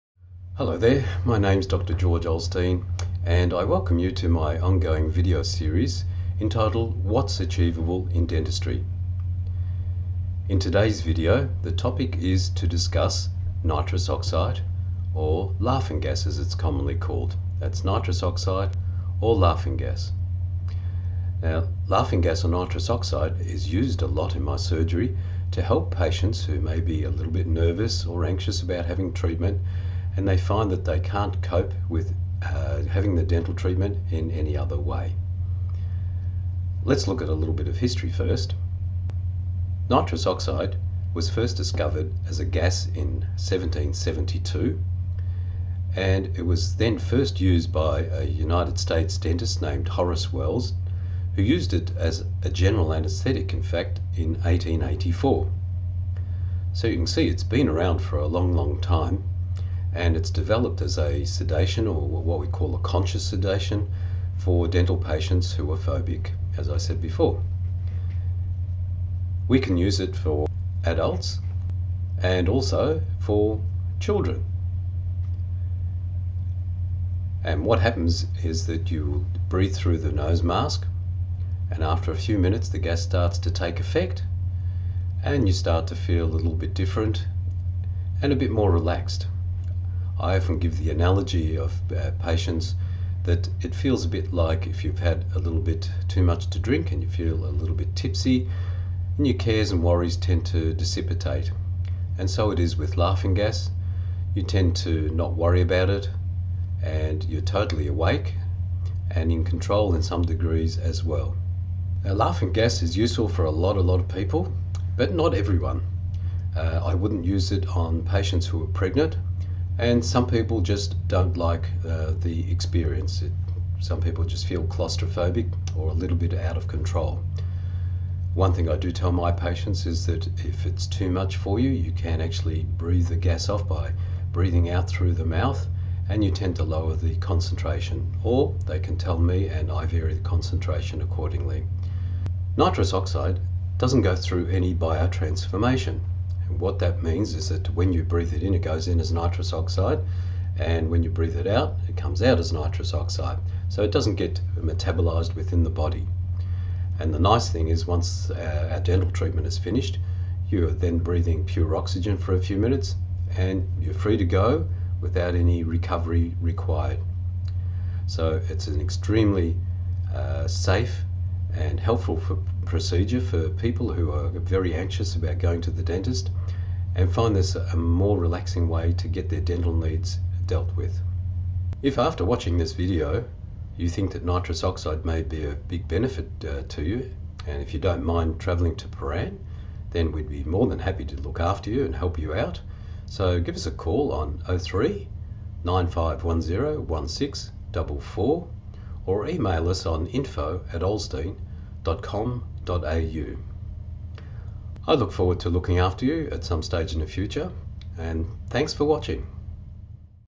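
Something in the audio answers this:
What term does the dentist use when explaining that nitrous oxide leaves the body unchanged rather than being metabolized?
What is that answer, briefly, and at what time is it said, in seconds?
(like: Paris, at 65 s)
biotransformation, at 144 s.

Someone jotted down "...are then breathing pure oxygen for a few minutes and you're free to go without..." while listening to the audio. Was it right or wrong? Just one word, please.
right.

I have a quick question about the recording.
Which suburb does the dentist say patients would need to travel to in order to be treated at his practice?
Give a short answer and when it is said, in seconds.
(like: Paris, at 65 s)
Prahran, at 188 s.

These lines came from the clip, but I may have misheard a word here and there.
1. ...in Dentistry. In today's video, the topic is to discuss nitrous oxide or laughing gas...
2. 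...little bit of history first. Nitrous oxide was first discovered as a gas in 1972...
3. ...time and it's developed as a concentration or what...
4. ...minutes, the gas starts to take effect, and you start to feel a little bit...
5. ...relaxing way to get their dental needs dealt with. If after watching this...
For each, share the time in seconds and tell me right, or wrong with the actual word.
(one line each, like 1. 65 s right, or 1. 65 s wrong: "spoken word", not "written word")
1. 8 s right
2. 37 s wrong: "1772", not "1972"
3. 58 s wrong: "sedation", not "concentration"
4. 82 s right
5. 178 s right.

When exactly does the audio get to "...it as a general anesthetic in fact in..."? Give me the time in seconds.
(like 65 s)
51 s.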